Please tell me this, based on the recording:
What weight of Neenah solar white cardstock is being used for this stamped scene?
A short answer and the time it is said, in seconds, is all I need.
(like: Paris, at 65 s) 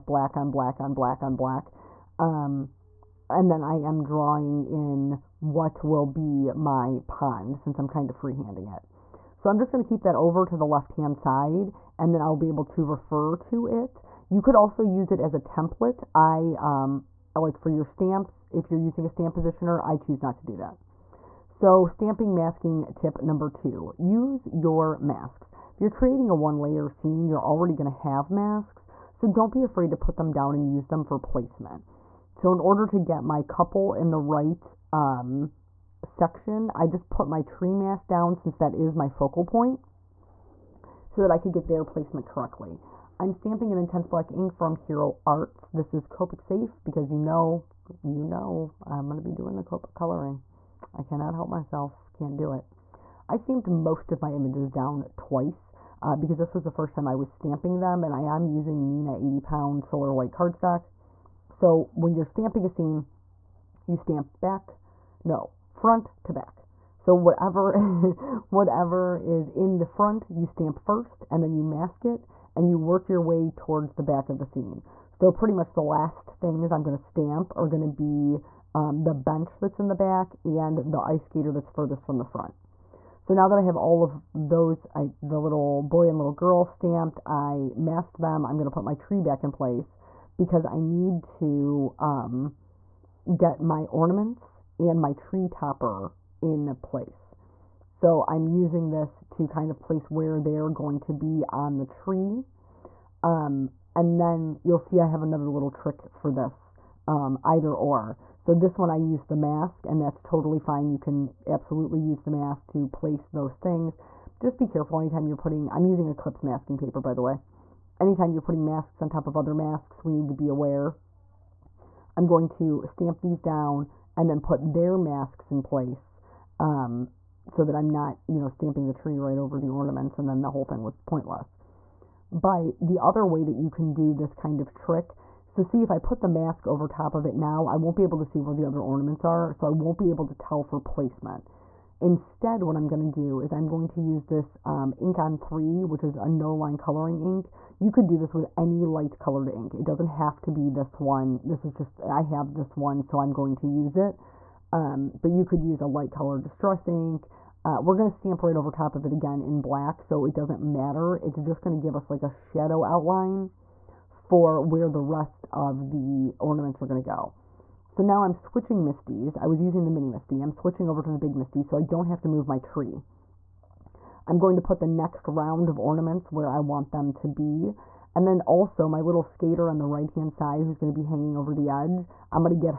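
80 pound, at 59 s.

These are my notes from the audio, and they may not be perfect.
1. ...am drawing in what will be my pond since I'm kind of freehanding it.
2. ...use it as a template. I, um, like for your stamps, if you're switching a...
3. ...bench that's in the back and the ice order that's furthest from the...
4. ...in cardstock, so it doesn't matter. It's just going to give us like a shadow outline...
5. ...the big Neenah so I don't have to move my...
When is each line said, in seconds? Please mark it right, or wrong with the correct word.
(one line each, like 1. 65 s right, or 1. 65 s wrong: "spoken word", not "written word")
1. 3 s right
2. 14 s wrong: "using", not "switching"
3. 79 s wrong: "skater", not "order"
4. 159 s wrong: "black", not "cardstock"
5. 171 s wrong: "MISTI", not "Neenah".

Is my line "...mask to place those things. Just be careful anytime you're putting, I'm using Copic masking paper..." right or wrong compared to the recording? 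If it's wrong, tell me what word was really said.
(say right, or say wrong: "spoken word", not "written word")
wrong: "Eclipse", not "Copic".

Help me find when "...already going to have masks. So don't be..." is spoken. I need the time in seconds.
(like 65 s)
27 s.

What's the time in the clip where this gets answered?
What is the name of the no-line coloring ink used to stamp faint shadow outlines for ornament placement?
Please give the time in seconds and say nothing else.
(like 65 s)
144 s.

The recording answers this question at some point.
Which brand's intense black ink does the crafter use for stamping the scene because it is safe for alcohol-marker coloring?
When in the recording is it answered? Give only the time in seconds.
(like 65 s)
44 s.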